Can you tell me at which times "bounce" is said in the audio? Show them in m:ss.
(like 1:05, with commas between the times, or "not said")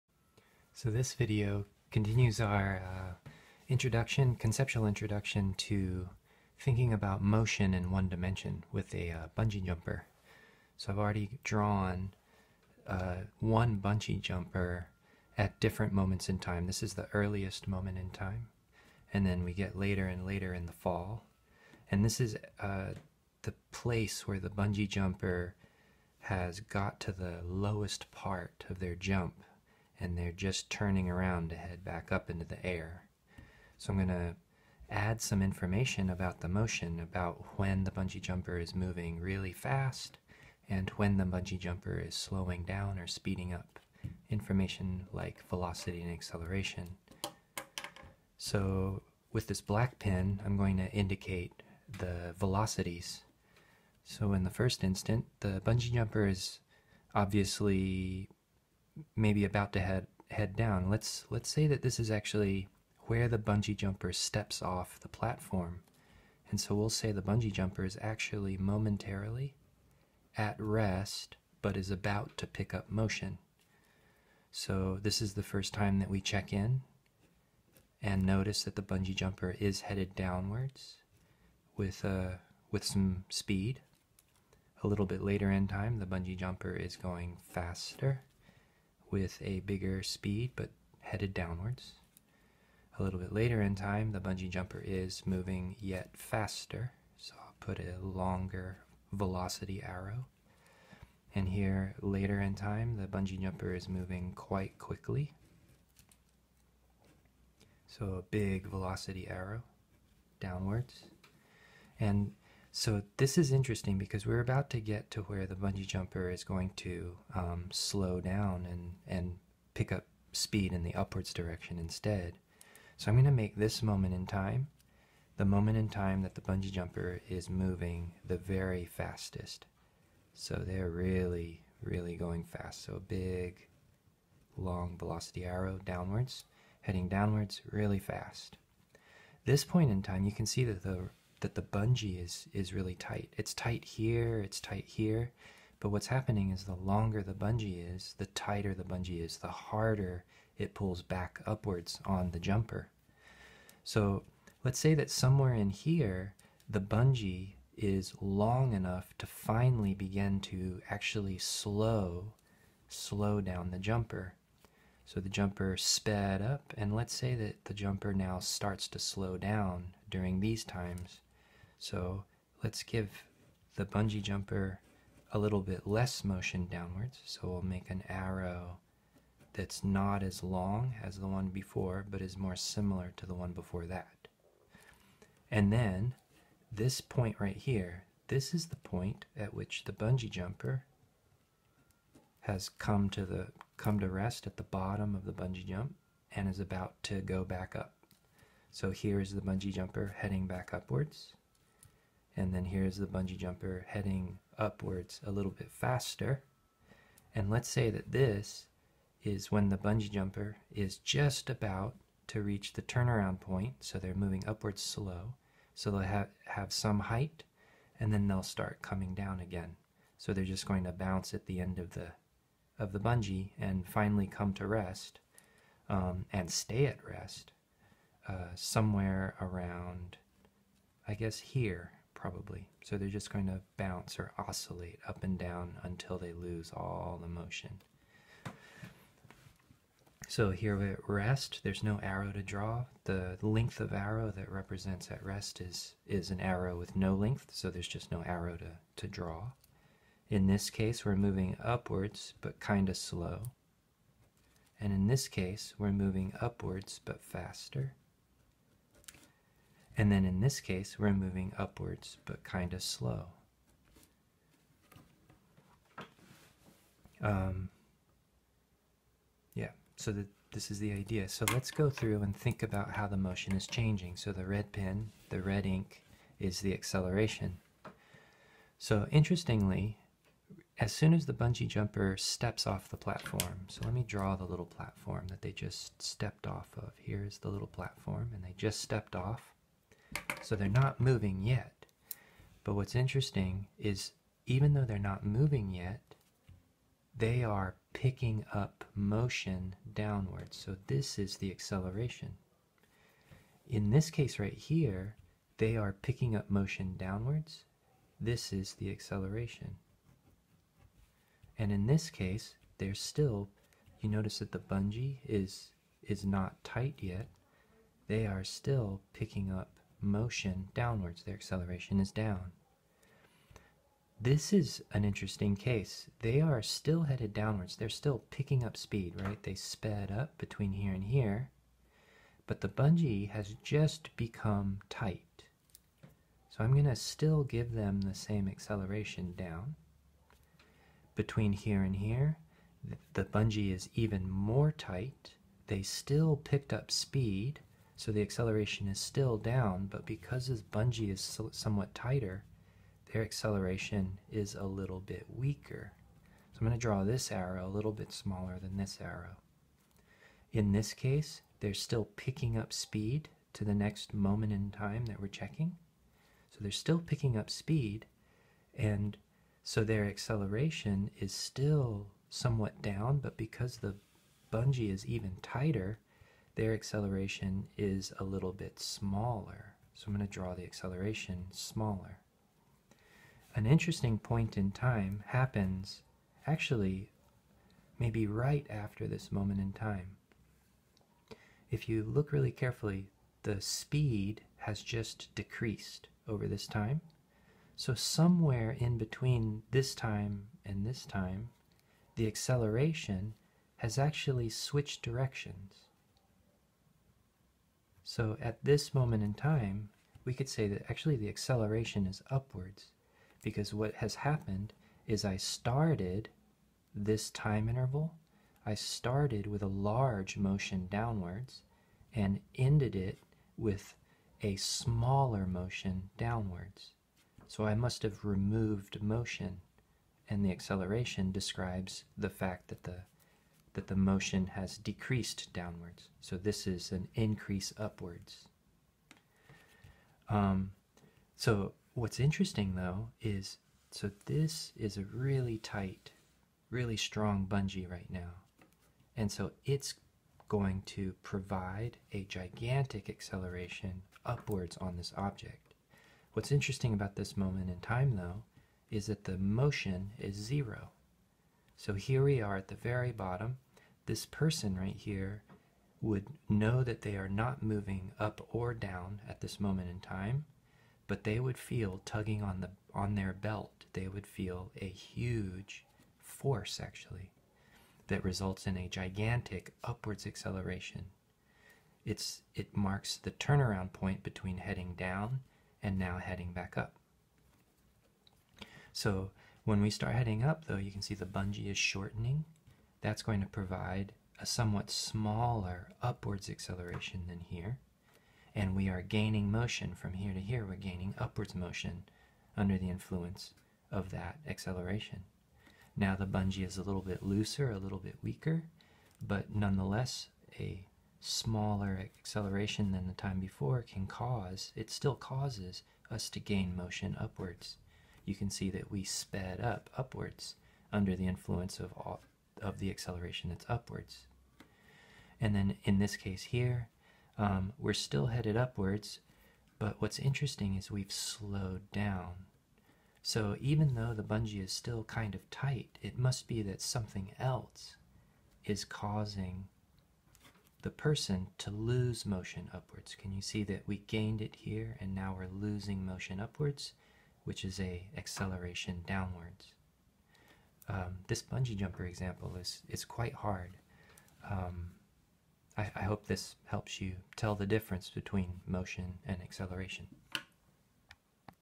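3:40, 3:53.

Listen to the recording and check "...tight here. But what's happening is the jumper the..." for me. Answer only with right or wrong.
wrong.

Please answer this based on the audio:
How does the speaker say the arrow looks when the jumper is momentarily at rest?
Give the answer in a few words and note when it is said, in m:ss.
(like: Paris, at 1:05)
an arrow with no length, at 4:06.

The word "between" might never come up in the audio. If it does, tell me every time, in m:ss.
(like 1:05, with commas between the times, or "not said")
5:30, 5:41, 6:38, 8:04, 9:18.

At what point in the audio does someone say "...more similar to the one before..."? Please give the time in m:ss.
3:02.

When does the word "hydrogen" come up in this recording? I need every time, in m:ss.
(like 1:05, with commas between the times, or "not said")
not said.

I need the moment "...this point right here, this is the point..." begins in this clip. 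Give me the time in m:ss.
3:06.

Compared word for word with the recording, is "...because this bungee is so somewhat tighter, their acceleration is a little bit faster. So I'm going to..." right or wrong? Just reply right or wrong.
wrong.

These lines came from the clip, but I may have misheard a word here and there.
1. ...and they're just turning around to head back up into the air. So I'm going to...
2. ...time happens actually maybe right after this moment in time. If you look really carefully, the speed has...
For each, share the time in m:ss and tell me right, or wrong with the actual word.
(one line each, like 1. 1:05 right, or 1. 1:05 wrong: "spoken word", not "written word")
1. 0:30 right
2. 6:24 right.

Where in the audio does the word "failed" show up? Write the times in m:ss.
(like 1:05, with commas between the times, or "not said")
not said.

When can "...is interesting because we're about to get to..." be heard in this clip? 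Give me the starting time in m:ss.
1:53.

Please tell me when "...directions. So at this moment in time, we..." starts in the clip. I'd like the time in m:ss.
6:45.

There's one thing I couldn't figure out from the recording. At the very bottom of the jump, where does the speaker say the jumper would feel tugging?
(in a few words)
on their belt.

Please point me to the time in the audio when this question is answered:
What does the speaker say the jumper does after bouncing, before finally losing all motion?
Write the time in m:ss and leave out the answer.
3:54.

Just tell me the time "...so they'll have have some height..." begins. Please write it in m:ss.
3:35.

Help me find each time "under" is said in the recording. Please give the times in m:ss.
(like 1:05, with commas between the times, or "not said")
8:22, 8:40.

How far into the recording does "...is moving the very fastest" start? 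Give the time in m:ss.
2:07.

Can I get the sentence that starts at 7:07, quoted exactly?
So I must have removed motion and the acceleration describes the fact that the that the motion has decreased downwards.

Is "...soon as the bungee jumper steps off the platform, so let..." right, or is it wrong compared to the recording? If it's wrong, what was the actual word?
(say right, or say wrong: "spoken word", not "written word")
right.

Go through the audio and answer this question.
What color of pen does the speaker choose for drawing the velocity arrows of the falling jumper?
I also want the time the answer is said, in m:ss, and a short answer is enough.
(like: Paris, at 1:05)
black, at 0:49.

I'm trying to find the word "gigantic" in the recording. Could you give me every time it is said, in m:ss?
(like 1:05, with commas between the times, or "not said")
7:32, 7:58.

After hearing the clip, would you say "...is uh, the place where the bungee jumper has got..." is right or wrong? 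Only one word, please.
right.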